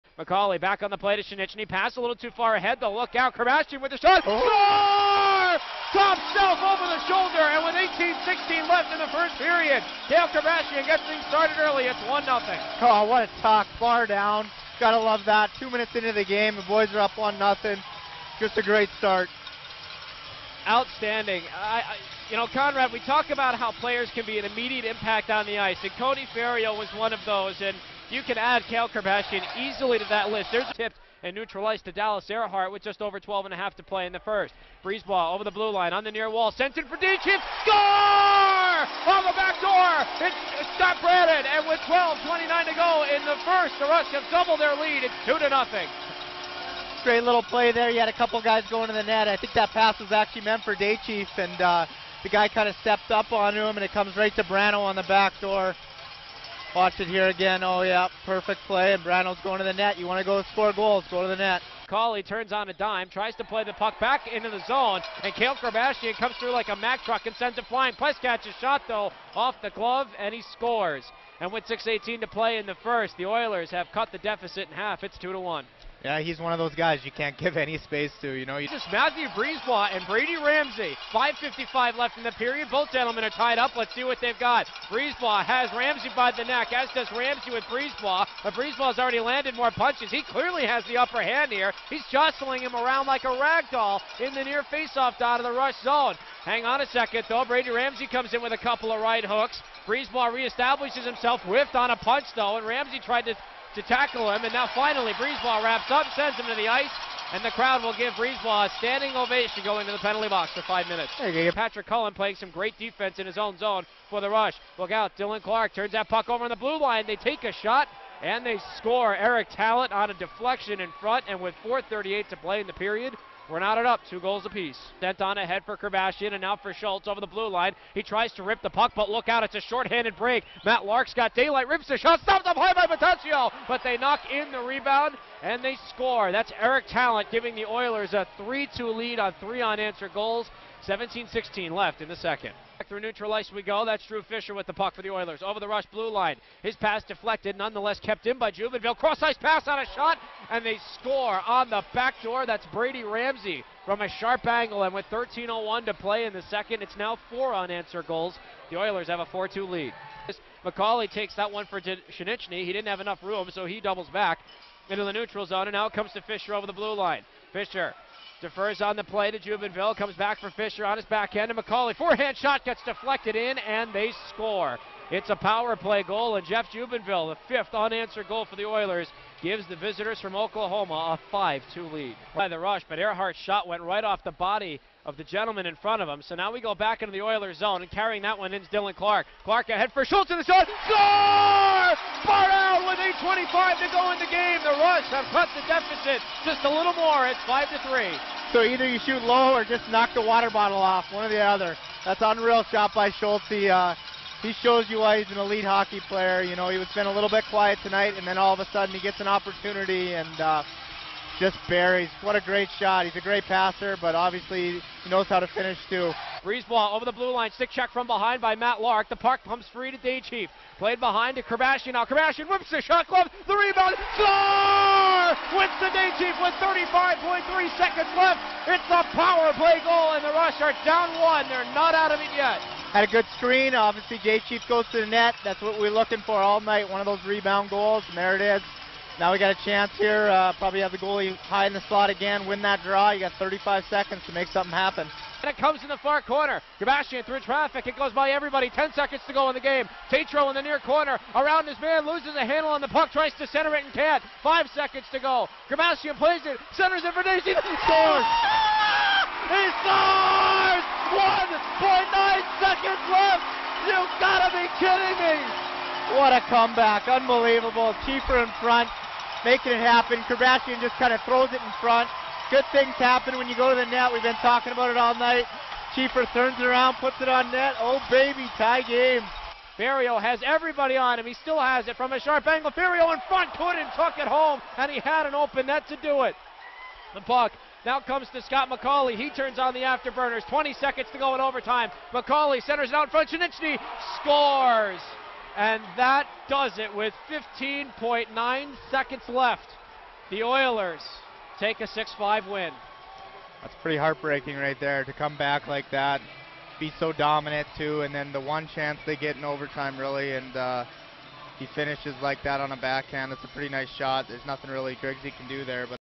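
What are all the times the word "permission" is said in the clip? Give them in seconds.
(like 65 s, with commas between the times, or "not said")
not said.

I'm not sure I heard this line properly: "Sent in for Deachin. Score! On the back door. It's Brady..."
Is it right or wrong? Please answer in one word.
wrong.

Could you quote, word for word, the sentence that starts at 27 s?
And you can add Kale Kerbashian easily to that list.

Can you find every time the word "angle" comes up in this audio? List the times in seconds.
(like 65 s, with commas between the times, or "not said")
154 s, 282 s.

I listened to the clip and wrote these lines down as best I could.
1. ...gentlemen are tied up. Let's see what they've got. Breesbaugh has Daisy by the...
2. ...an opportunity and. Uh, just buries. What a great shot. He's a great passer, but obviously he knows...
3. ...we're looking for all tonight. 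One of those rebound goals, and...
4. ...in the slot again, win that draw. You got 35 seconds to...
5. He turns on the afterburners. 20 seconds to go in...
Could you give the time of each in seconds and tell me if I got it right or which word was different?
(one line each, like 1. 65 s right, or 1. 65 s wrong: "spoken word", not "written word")
1. 82 s wrong: "Ramsey", not "Daisy"
2. 209 s right
3. 235 s wrong: "night", not "tonight"
4. 241 s right
5. 289 s right.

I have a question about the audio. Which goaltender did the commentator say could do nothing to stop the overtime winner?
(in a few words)
Grigsby.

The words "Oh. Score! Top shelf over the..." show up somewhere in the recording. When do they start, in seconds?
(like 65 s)
4 s.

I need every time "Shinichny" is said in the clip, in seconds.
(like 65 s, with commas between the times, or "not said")
1 s, 161 s, 293 s.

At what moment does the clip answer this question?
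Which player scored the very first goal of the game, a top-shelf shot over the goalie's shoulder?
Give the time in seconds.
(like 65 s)
10 s.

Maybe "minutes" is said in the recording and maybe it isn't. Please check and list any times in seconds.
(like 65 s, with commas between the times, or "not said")
15 s, 110 s.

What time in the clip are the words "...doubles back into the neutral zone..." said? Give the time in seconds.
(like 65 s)
163 s.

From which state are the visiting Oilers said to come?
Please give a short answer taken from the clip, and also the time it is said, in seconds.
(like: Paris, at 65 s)
Oklahoma, at 180 s.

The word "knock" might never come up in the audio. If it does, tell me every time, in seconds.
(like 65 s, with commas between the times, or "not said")
133 s, 199 s.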